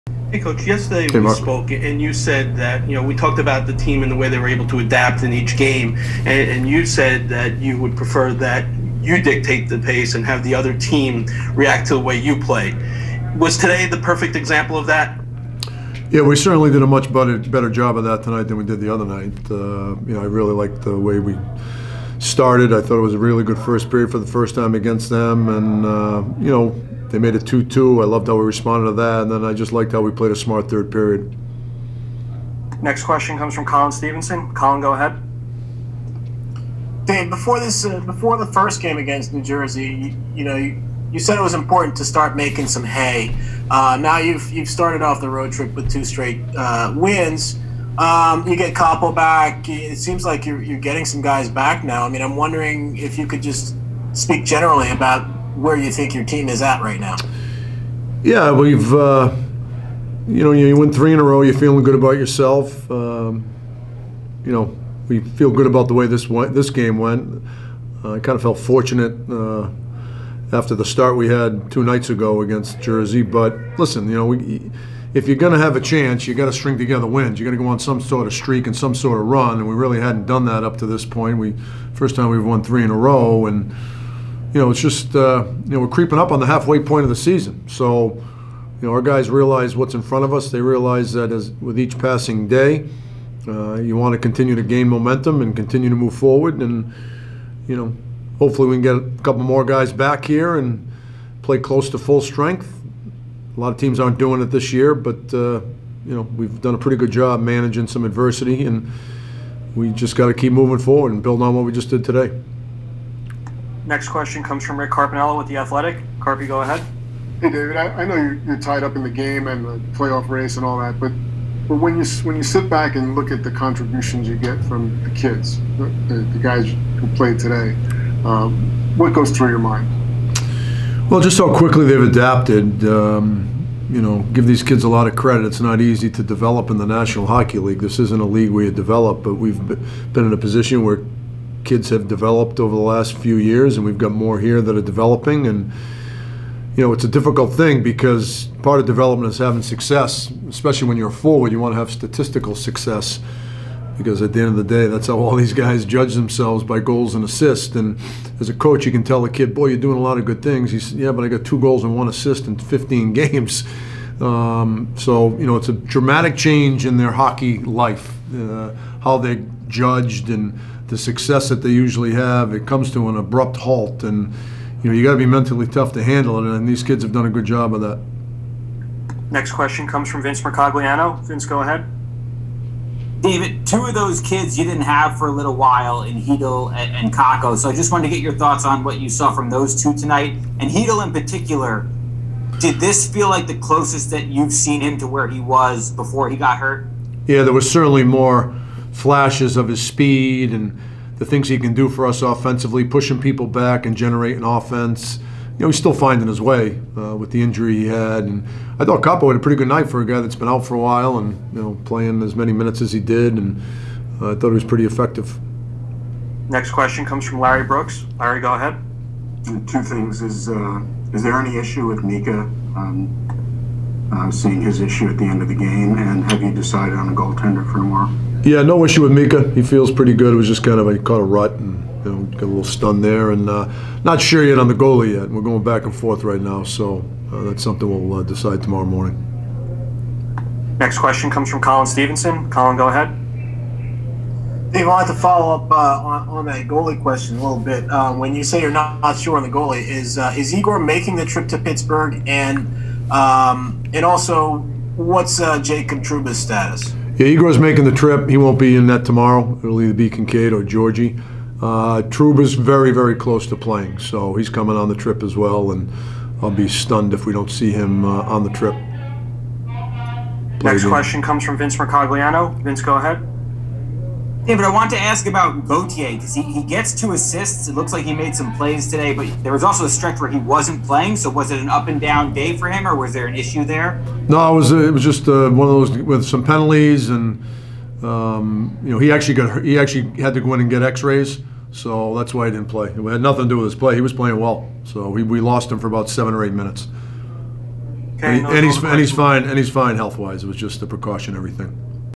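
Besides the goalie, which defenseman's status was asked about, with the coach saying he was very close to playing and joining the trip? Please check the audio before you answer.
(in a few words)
Jacob Trouba.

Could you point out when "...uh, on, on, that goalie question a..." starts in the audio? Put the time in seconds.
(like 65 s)
245 s.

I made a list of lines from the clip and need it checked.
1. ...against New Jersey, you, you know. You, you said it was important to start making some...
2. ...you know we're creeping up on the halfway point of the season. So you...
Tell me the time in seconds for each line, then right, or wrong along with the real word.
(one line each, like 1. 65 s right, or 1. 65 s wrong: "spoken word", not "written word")
1. 38 s right
2. 85 s right.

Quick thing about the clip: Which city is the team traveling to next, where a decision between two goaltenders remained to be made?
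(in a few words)
Pittsburgh.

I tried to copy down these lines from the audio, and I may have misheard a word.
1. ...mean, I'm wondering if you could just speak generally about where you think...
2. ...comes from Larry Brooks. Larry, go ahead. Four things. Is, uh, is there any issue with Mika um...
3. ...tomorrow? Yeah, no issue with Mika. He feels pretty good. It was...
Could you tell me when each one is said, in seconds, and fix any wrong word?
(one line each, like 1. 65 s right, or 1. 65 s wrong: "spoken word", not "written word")
1. 52 s right
2. 217 s wrong: "Two", not "Four"
3. 227 s right.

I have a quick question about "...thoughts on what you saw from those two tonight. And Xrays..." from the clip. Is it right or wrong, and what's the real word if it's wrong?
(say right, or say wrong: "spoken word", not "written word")
wrong: "Chytil", not "Xrays".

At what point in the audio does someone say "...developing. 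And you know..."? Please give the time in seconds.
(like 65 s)
144 s.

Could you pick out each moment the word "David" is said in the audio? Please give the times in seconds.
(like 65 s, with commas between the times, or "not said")
117 s, 183 s, 274 s.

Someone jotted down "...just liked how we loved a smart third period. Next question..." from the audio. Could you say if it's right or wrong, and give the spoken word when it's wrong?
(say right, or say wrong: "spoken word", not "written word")
wrong: "played", not "loved".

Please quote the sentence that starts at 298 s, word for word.
Okay, and, he, no, and, he's, and he's fine.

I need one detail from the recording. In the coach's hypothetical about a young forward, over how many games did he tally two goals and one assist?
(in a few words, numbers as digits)
15.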